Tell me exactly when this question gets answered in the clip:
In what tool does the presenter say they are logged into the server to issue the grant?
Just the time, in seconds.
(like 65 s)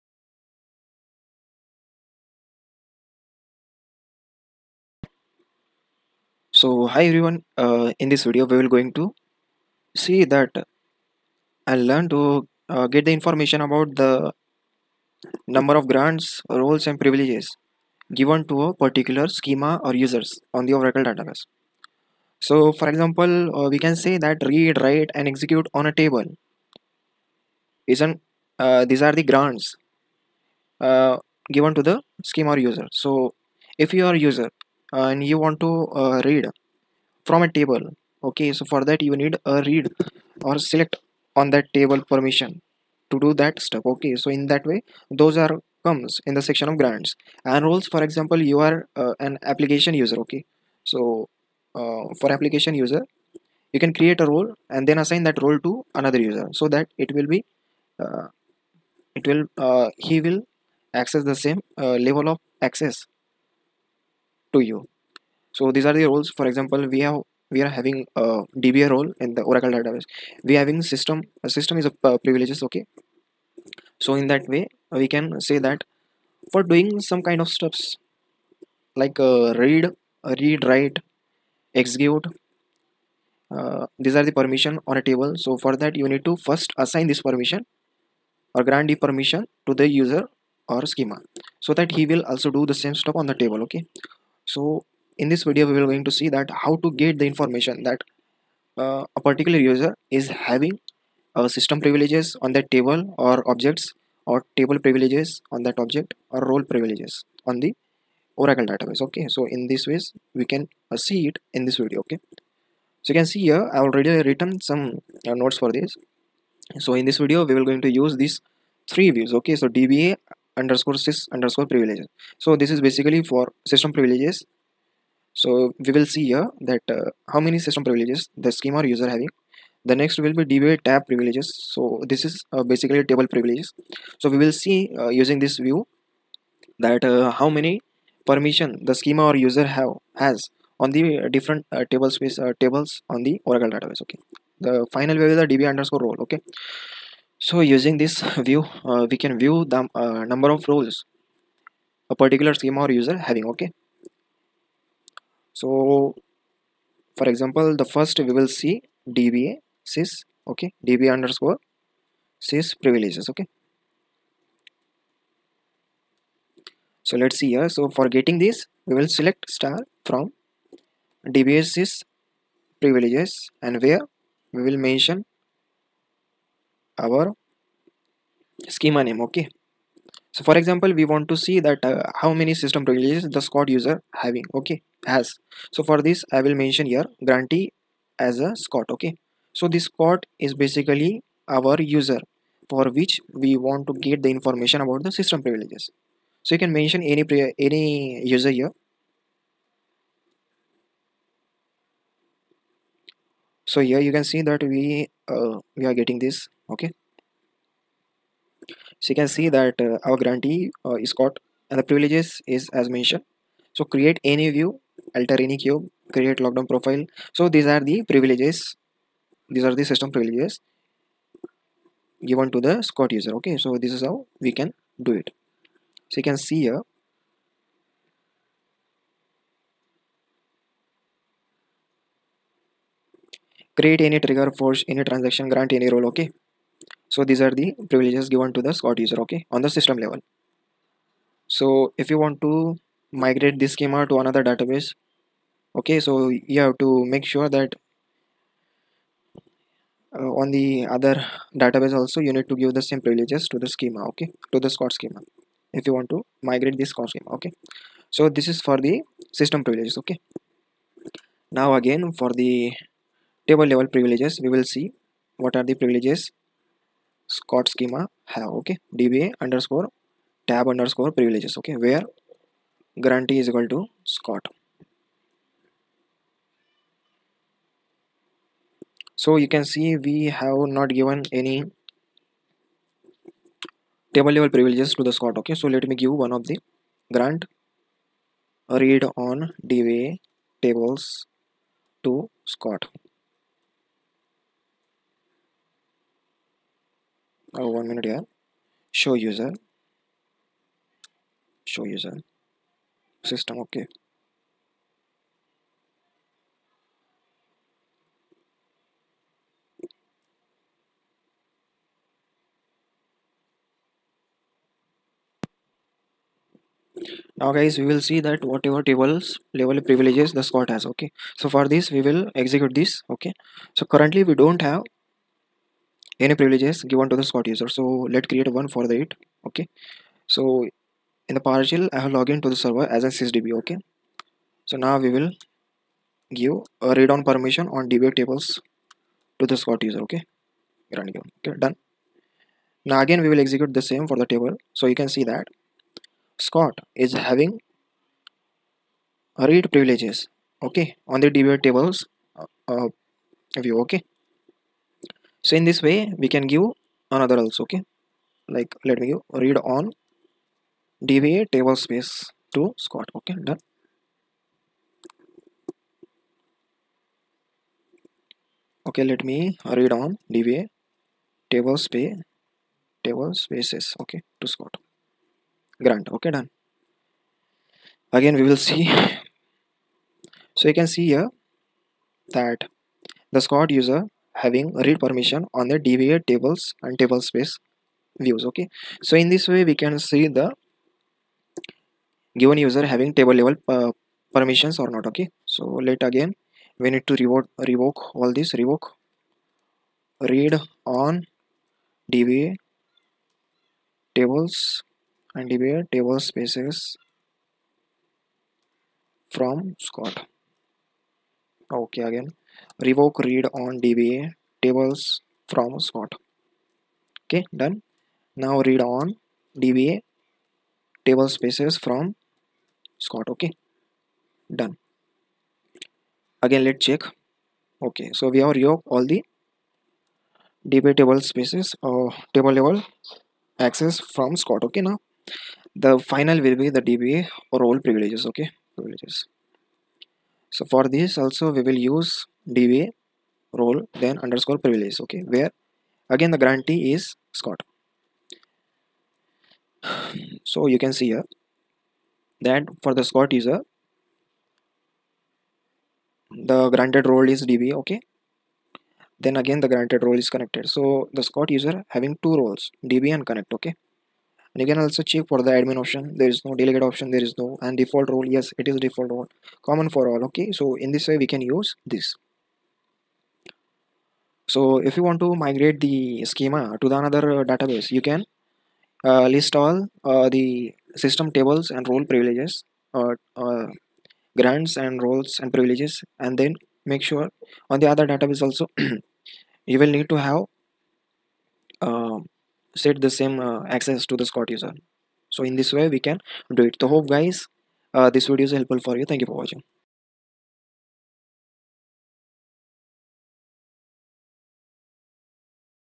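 331 s.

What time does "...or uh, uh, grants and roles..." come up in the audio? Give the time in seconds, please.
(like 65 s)
483 s.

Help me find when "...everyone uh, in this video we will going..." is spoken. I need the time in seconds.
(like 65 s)
7 s.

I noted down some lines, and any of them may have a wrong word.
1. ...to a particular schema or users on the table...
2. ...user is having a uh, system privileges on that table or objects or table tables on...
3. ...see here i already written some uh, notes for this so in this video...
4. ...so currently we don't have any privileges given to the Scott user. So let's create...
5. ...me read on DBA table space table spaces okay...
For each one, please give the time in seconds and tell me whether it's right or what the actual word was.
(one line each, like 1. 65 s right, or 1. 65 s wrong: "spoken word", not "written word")
1. 18 s wrong: "oracle", not "table"
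2. 99 s wrong: "privileges", not "tables"
3. 113 s right
4. 323 s right
5. 369 s right.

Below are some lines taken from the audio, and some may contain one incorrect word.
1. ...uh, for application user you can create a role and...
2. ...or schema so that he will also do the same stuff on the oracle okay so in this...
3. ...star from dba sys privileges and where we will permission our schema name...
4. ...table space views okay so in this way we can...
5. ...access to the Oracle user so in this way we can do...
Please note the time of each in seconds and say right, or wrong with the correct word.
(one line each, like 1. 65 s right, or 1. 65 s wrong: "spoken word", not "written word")
1. 51 s right
2. 90 s wrong: "table", not "oracle"
3. 169 s wrong: "mention", not "permission"
4. 386 s right
5. 493 s wrong: "Scott", not "Oracle".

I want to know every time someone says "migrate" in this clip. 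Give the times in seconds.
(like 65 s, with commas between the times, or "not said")
243 s, 256 s, 475 s.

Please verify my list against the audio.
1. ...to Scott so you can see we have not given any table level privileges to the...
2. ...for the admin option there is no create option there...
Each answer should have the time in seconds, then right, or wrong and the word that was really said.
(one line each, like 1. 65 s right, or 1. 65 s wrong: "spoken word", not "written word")
1. 273 s right
2. 465 s wrong: "delegate", not "create".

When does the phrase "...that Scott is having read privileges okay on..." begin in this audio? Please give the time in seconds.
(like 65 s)
345 s.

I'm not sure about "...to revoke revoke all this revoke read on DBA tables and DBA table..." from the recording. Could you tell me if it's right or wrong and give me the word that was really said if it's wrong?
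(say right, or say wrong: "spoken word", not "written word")
right.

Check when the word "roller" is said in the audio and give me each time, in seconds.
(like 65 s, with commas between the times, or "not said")
not said.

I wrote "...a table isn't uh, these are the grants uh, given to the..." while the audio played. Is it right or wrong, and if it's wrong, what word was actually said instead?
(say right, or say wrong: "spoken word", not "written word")
right.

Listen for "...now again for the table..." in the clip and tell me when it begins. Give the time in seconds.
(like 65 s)
261 s.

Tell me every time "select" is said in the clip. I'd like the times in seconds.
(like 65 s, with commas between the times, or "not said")
40 s, 169 s.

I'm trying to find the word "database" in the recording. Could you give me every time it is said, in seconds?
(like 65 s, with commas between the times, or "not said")
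21 s, 69 s, 108 s, 143 s, 244 s, 251 s, 477 s, 488 s.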